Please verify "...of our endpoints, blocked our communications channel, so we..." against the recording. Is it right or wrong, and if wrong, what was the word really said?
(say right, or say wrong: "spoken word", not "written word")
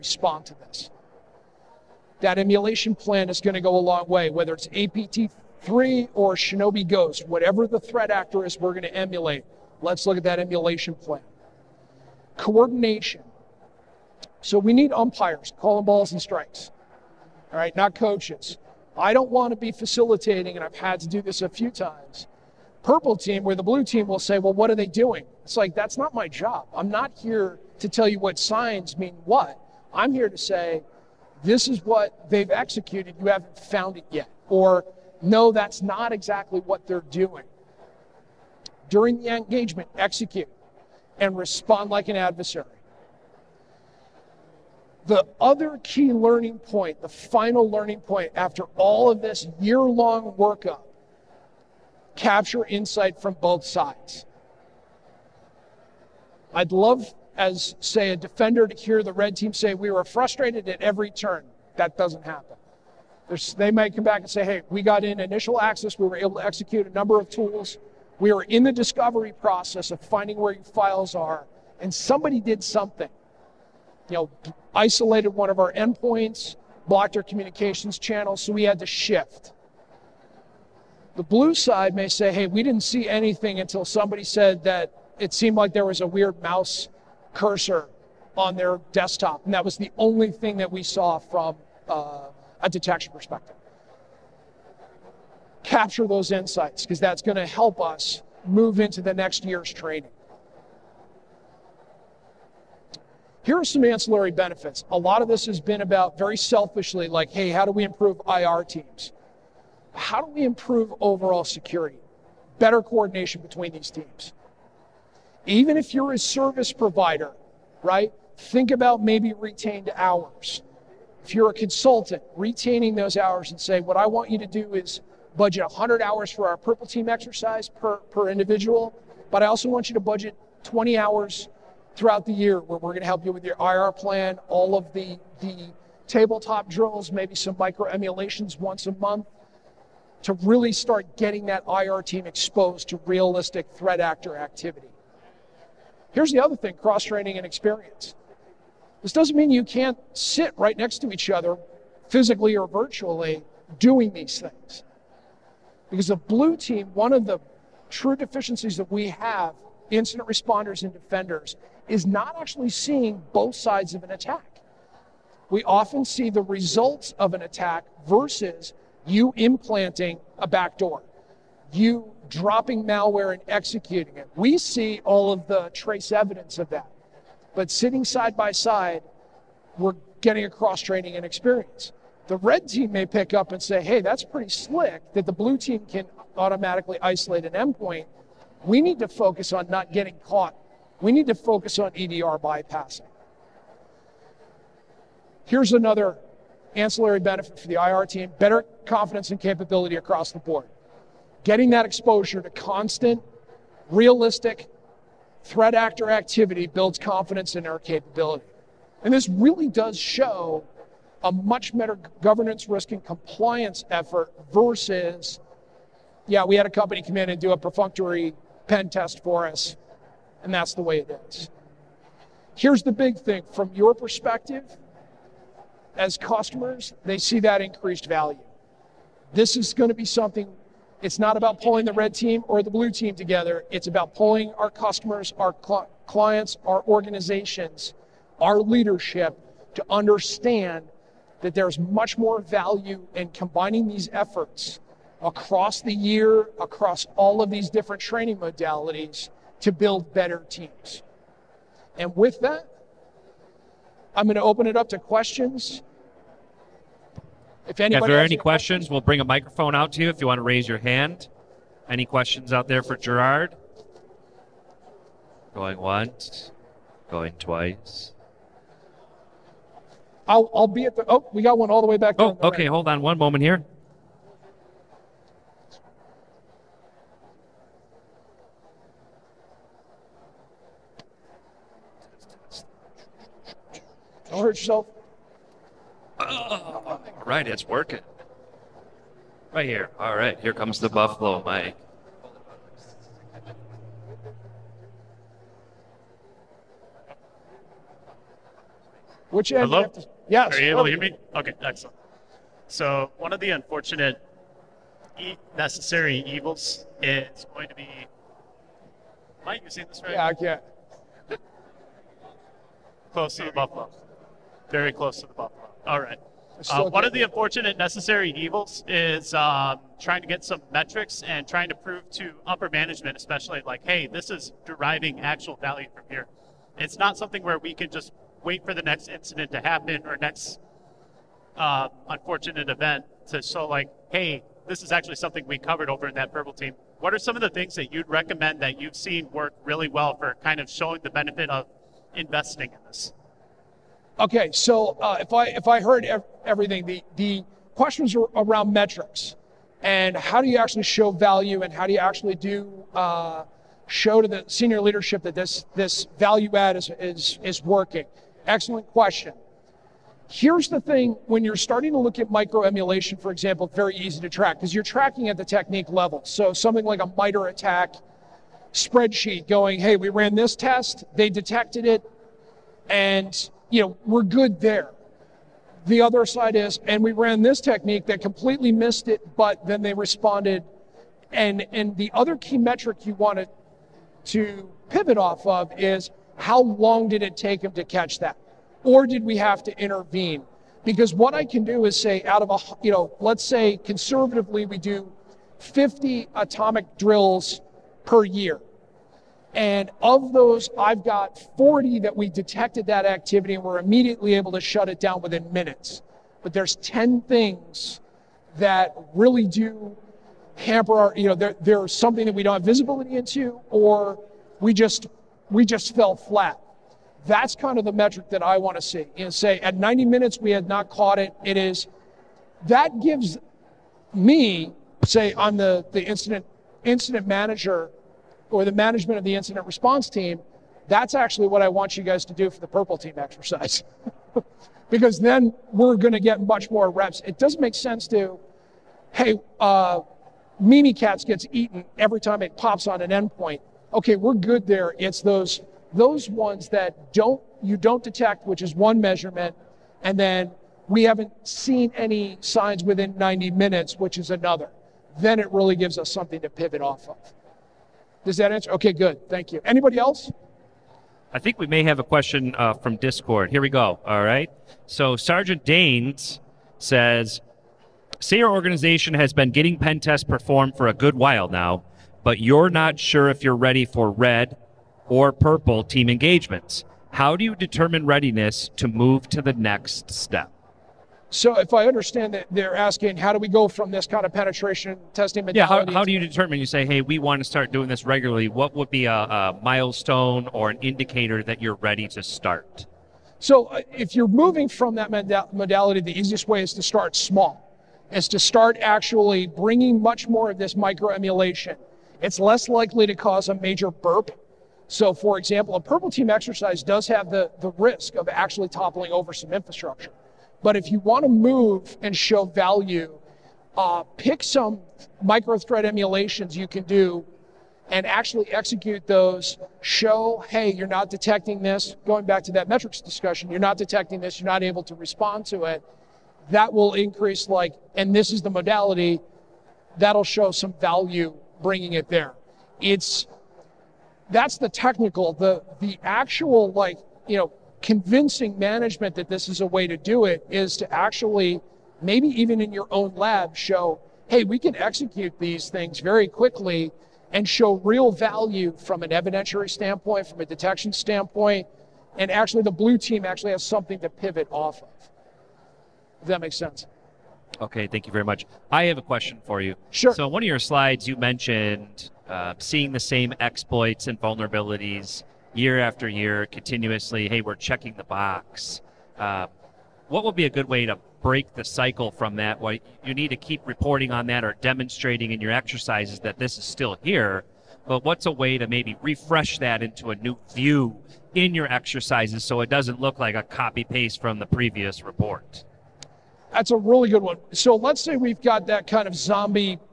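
right.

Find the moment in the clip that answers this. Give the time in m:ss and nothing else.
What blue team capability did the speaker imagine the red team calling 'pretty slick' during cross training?
3:06.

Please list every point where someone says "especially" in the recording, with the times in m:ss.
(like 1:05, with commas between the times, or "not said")
5:23.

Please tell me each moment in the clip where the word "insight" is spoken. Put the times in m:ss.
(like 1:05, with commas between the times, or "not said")
0:52, 1:36.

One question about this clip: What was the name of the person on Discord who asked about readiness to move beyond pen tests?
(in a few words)
Sergeant Danes.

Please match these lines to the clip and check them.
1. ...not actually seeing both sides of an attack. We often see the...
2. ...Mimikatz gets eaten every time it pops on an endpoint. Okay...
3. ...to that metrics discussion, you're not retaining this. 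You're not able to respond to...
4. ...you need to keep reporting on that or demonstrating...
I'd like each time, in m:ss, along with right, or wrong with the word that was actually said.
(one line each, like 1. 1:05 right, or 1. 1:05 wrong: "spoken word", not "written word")
1. 2:42 right
2. 7:20 right
3. 8:42 wrong: "detecting", not "retaining"
4. 9:33 right.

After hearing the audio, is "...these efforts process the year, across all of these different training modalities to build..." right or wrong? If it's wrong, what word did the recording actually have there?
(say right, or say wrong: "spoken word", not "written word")
wrong: "across", not "process".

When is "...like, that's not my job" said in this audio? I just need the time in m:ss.
0:25.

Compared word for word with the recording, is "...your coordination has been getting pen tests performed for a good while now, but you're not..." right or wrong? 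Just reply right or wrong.
wrong.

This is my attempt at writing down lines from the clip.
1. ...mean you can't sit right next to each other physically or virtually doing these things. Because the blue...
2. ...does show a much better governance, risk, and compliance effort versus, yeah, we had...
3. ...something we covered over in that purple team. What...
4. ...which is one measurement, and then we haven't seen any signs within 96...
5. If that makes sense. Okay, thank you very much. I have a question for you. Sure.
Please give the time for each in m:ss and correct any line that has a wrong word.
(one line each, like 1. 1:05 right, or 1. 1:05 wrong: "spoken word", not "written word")
1. 2:29 right
2. 3:29 right
3. 5:35 right
4. 7:28 wrong: "90", not "96"
5. 9:16 right.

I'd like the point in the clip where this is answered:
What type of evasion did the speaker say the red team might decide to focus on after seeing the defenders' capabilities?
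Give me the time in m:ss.
3:11.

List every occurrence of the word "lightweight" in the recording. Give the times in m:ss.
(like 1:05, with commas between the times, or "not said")
not said.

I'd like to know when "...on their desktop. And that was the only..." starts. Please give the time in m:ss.
1:28.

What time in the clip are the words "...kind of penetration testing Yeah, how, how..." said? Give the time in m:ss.
8:04.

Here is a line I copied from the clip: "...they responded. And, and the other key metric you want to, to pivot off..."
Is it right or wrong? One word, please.
right.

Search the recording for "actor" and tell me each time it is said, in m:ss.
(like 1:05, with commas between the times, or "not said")
0:08, 2:23, 3:25.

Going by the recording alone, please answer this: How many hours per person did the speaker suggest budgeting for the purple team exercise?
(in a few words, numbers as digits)
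100.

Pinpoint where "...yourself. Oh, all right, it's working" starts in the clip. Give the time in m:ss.
4:44.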